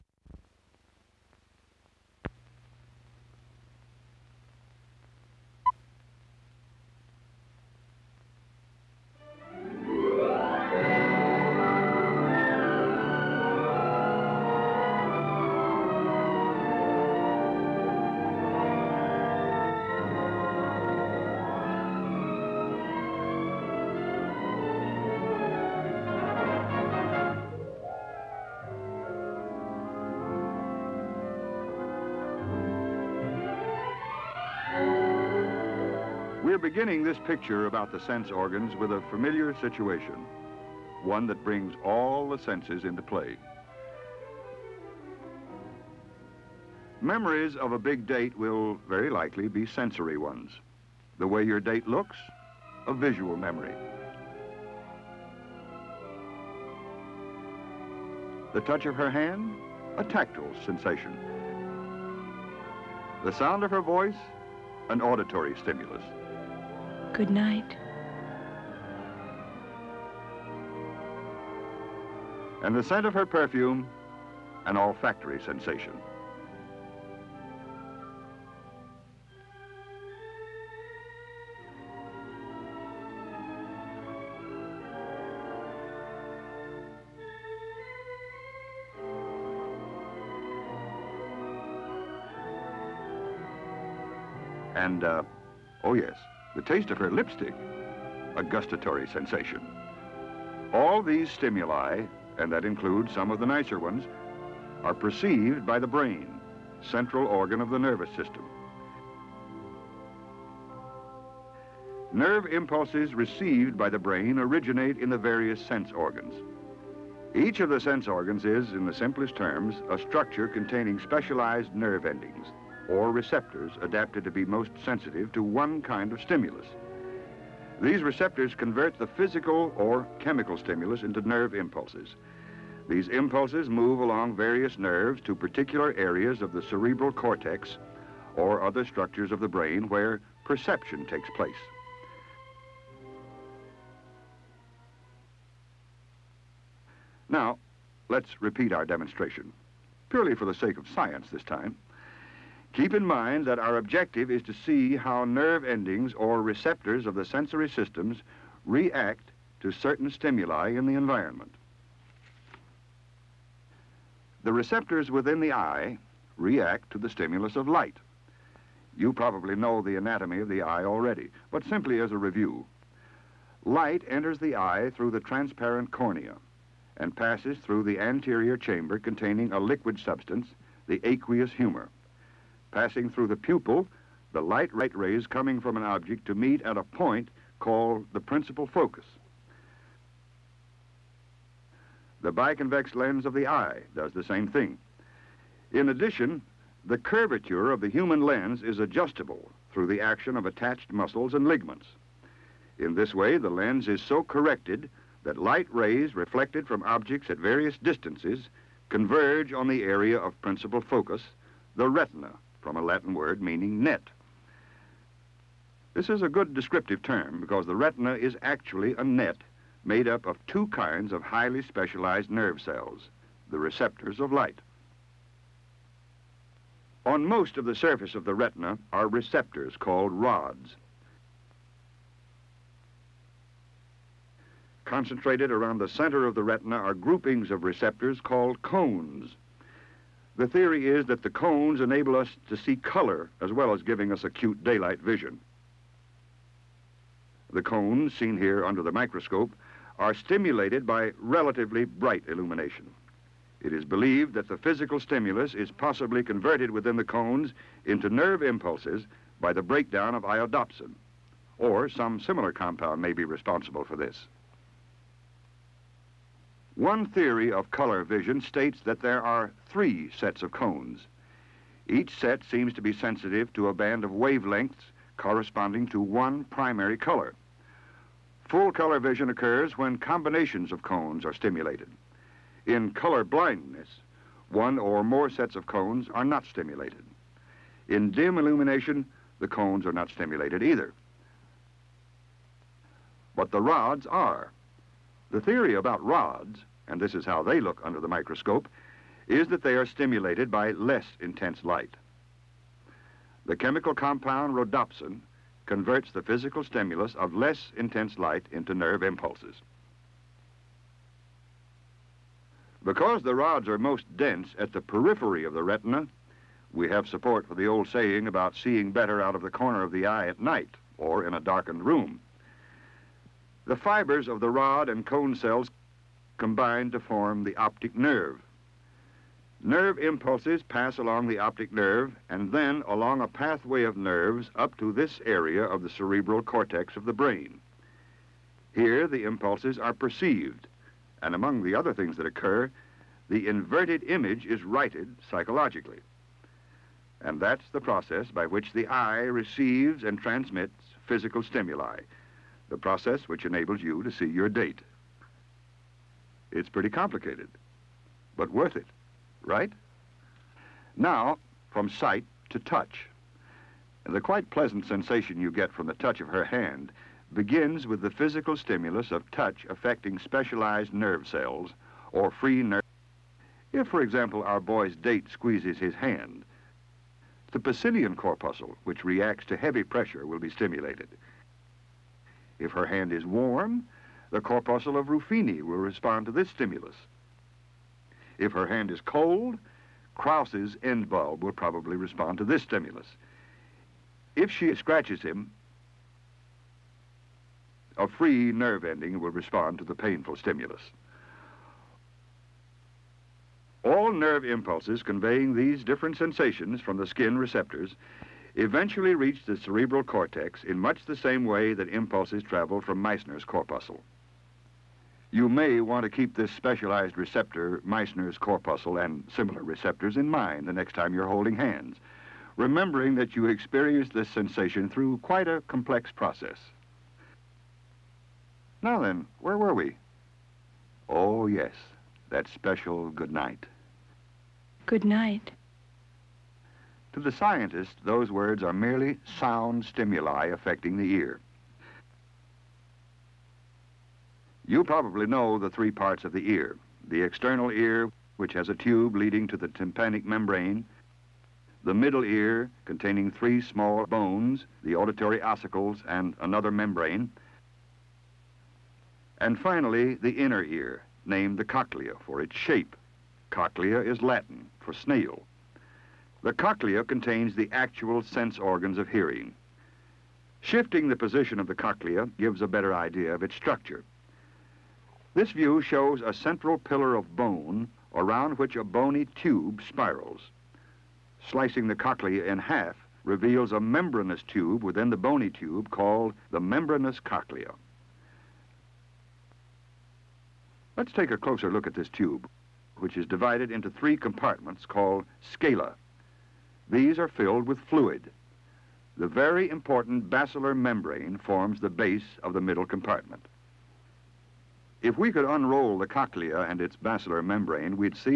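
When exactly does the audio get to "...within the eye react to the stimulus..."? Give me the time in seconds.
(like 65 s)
165 s.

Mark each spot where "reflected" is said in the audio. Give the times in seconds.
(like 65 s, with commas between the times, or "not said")
206 s.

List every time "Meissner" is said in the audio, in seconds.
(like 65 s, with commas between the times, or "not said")
413 s, 417 s.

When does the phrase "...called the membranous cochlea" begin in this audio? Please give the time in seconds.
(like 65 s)
485 s.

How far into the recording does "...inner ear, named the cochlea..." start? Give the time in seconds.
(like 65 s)
460 s.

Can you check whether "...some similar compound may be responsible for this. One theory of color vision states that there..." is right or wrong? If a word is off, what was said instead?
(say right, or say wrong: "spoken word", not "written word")
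right.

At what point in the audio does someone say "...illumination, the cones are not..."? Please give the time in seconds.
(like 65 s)
288 s.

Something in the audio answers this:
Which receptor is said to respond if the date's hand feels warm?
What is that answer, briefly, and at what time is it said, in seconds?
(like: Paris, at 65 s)
corpuscle of Ruffini, at 384 s.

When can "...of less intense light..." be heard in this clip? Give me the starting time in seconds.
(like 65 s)
307 s.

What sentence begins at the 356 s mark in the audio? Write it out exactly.
It's pretty complicated, but worth it, right?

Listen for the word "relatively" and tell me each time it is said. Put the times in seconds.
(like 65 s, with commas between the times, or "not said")
251 s.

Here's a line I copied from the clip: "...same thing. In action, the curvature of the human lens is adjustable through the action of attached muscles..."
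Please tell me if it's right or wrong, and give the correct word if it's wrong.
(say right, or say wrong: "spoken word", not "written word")
wrong: "addition", not "action".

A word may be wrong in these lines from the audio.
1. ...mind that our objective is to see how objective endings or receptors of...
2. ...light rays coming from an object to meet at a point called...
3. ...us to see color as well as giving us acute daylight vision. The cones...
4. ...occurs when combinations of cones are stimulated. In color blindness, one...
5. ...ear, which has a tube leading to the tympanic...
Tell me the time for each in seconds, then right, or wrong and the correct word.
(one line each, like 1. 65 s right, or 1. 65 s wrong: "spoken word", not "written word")
1. 153 s wrong: "nerve", not "objective"
2. 184 s right
3. 242 s right
4. 279 s right
5. 447 s right.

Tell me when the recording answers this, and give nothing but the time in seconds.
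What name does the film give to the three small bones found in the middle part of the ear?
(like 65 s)
454 s.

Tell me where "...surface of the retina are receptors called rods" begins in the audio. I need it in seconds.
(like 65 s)
227 s.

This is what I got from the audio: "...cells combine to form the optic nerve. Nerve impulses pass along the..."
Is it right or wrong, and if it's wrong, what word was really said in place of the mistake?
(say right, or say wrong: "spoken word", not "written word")
right.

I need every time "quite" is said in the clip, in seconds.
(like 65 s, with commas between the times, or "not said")
364 s, 425 s.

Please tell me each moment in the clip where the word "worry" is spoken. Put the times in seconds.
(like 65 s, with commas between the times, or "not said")
not said.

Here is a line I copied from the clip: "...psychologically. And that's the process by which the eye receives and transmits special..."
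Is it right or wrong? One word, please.
wrong.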